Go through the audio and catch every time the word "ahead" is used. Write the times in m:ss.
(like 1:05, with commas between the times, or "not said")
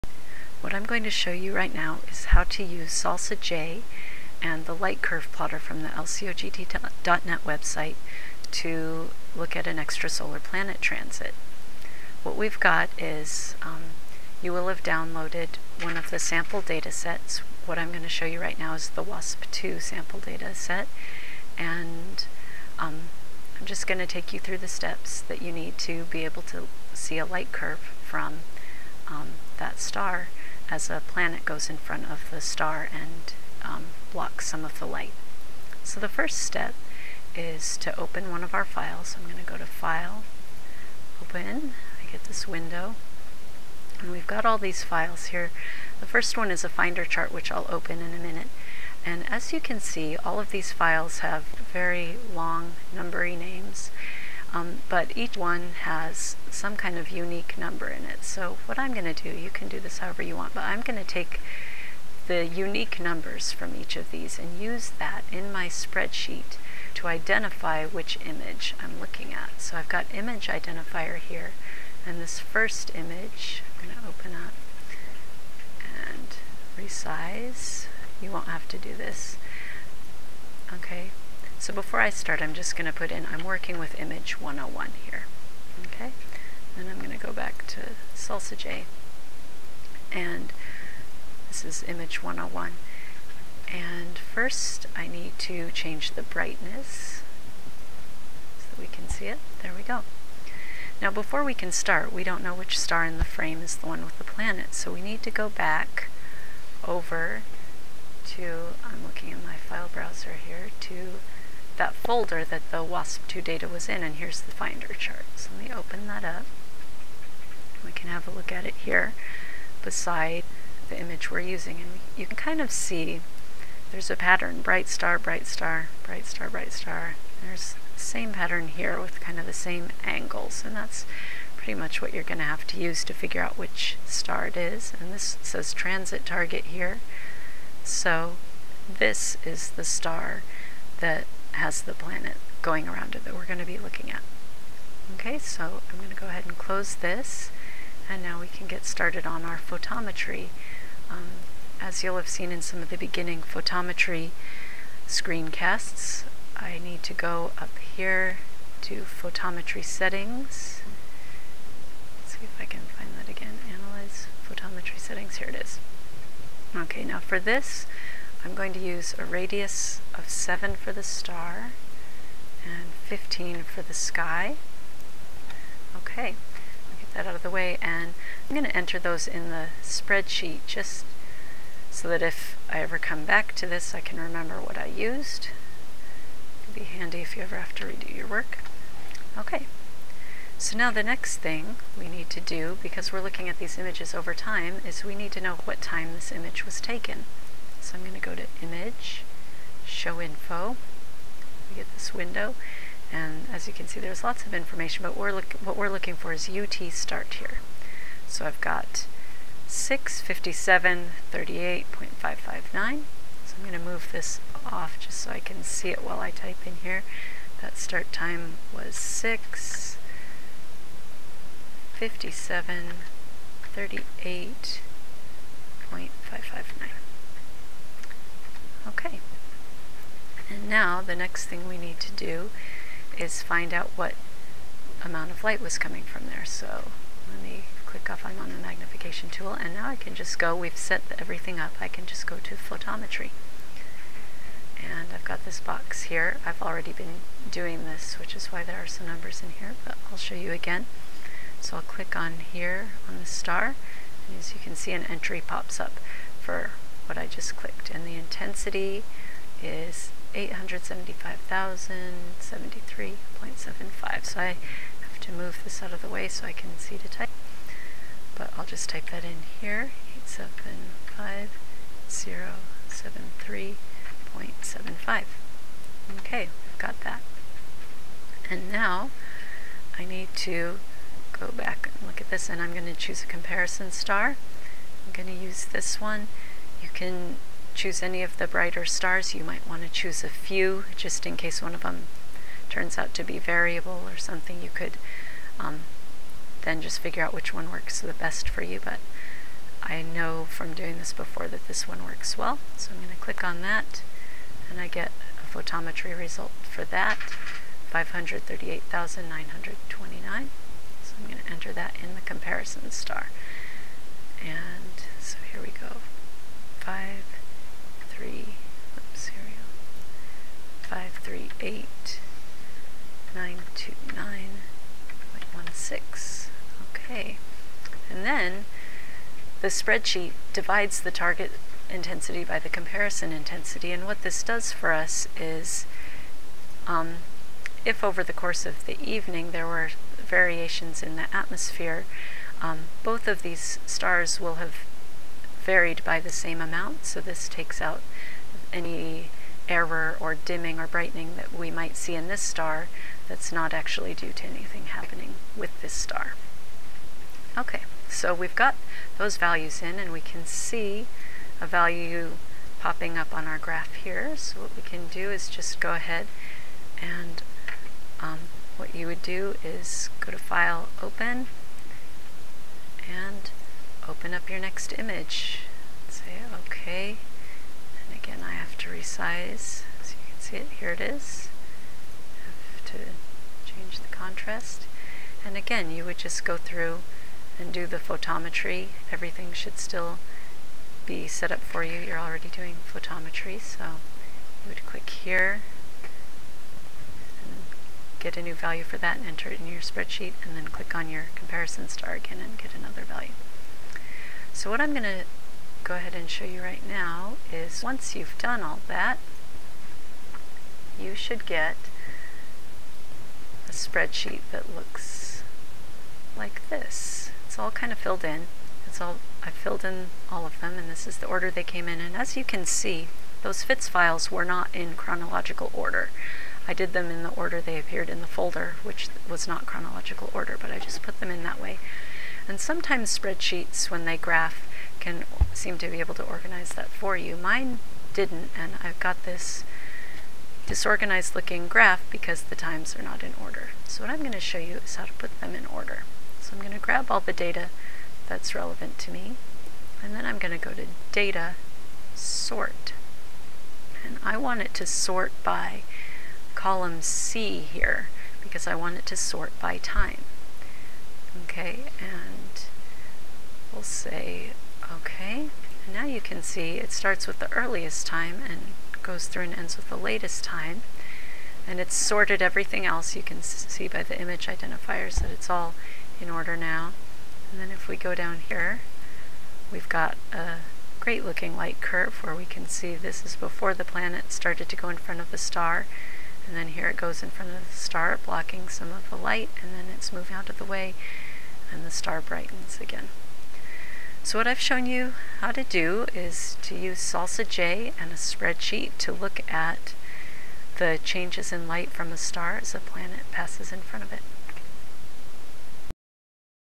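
2:26, 6:05, 6:45.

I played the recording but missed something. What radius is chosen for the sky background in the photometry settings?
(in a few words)
15.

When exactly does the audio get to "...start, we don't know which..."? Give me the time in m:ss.
1:41.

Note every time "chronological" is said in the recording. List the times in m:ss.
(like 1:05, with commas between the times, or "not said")
7:04, 7:09.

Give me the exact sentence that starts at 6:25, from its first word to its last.
And again, you would just go through and do the photometry.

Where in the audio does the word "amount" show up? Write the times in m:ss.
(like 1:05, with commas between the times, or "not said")
3:55, 5:46.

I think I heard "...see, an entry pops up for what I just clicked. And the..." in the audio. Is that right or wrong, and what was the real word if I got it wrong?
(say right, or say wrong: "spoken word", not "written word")
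right.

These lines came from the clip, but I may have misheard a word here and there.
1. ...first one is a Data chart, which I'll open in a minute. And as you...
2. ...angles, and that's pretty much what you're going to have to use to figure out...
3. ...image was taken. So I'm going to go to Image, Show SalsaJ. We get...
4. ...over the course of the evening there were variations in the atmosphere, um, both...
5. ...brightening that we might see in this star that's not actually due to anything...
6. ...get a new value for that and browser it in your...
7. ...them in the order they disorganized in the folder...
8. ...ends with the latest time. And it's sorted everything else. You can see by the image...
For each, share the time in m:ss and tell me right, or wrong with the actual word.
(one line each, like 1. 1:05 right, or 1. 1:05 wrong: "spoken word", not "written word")
1. 0:46 wrong: "Finder", not "Data"
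2. 2:10 right
3. 3:16 wrong: "Info", not "SalsaJ"
4. 5:38 right
5. 5:50 right
6. 6:38 wrong: "enter", not "browser"
7. 7:06 wrong: "appeared", not "disorganized"
8. 7:49 right.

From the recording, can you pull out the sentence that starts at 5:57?
Okay, so we've got those values in and we can see a value popping up on our graph here.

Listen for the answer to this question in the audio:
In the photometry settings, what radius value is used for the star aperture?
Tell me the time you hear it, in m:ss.
2:49.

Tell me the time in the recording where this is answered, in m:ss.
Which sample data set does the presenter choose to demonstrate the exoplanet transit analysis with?
0:19.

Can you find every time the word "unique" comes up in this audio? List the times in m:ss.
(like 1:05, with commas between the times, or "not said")
0:57, 1:02.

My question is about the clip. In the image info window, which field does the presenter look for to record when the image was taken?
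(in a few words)
UT start.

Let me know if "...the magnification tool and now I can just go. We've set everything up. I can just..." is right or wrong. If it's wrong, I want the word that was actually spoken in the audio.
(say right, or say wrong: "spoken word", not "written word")
right.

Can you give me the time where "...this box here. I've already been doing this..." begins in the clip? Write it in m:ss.
4:05.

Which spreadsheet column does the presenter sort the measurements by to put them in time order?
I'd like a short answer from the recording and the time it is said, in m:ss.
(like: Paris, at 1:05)
Column C, at 7:36.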